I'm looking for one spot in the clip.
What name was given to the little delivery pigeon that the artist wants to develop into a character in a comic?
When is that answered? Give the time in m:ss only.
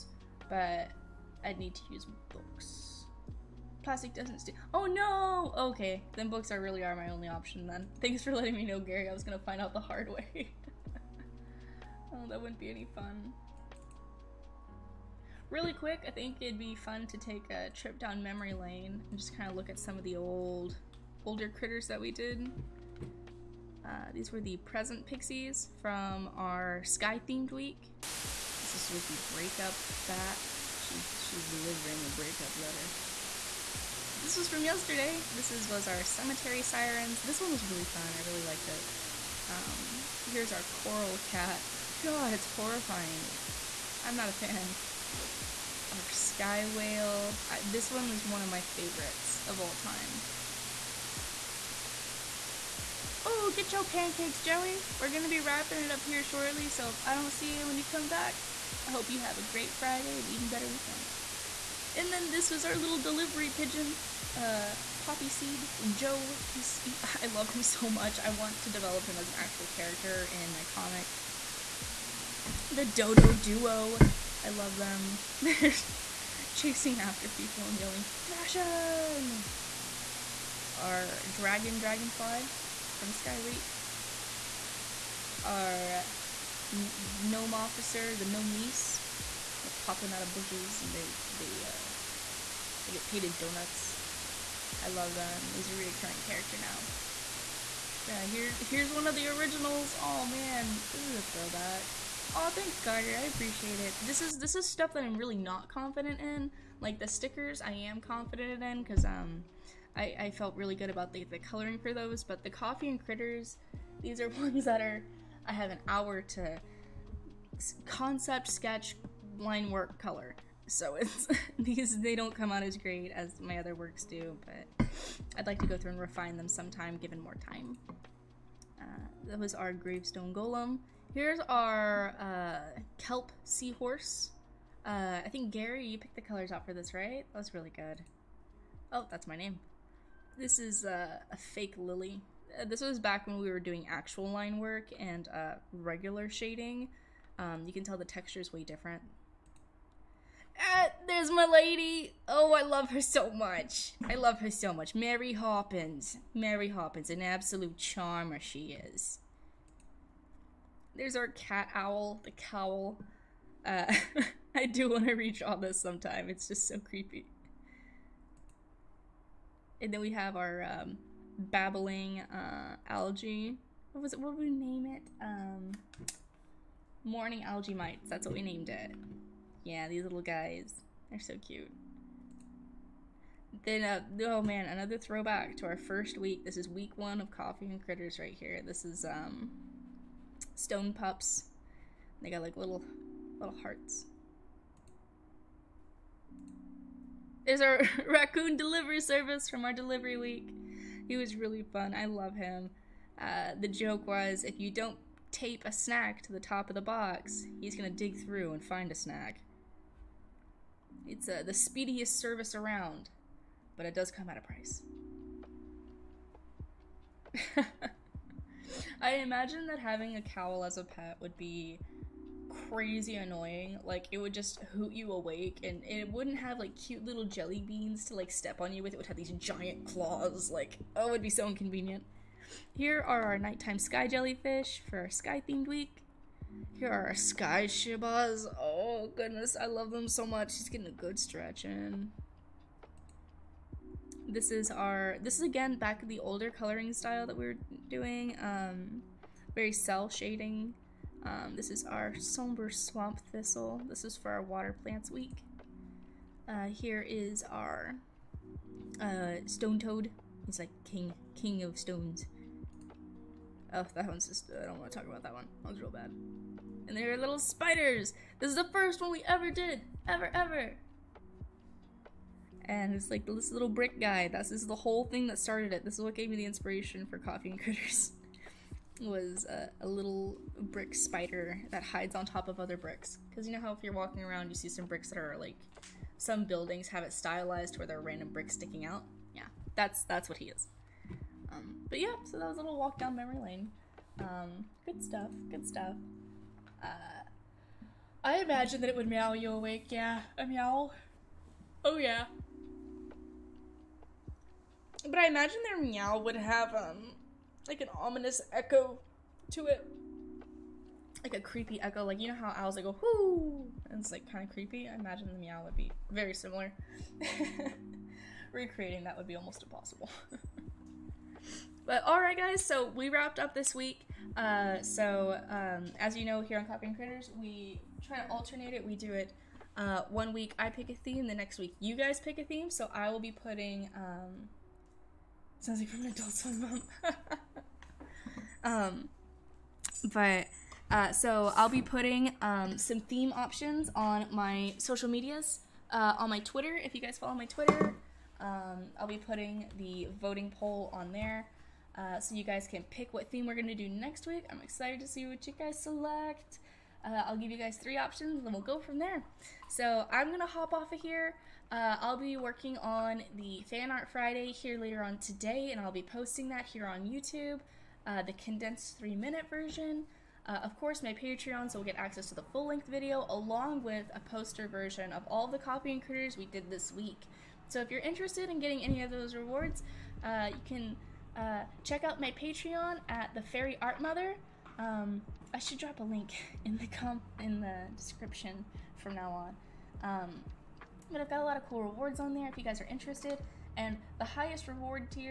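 1:04.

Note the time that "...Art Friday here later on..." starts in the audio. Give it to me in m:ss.
6:03.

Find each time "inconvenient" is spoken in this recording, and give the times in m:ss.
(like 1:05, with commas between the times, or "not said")
3:51.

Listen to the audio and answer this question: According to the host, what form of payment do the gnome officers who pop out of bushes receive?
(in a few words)
Donuts.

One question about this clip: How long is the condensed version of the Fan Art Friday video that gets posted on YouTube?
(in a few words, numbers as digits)
3 minutes.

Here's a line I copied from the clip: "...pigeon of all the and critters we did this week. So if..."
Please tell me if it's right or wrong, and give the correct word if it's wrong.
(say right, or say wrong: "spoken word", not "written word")
wrong: "version", not "pigeon".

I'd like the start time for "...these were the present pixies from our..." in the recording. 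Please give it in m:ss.
0:24.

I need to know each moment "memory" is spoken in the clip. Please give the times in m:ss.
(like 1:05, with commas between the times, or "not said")
0:18, 4:53.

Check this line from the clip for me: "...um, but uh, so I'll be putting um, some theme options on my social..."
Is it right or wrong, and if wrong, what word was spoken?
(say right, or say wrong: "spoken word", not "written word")
right.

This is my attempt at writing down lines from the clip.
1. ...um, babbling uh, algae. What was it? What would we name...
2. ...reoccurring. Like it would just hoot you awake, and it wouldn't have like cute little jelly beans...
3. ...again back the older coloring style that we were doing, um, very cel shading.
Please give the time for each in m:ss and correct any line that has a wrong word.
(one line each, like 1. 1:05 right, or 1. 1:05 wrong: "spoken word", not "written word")
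1. 2:50 right
2. 3:43 wrong: "annoying", not "reoccurring"
3. 4:05 right.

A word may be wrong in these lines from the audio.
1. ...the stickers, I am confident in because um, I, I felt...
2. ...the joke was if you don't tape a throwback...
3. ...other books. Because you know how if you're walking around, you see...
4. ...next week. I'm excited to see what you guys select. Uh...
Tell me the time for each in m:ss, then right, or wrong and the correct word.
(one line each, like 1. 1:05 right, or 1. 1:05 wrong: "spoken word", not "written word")
1. 1:46 right
2. 3:23 wrong: "snack", not "throwback"
3. 4:42 wrong: "bricks", not "books"
4. 5:53 right.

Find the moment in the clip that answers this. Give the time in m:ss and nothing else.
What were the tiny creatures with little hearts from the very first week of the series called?
3:10.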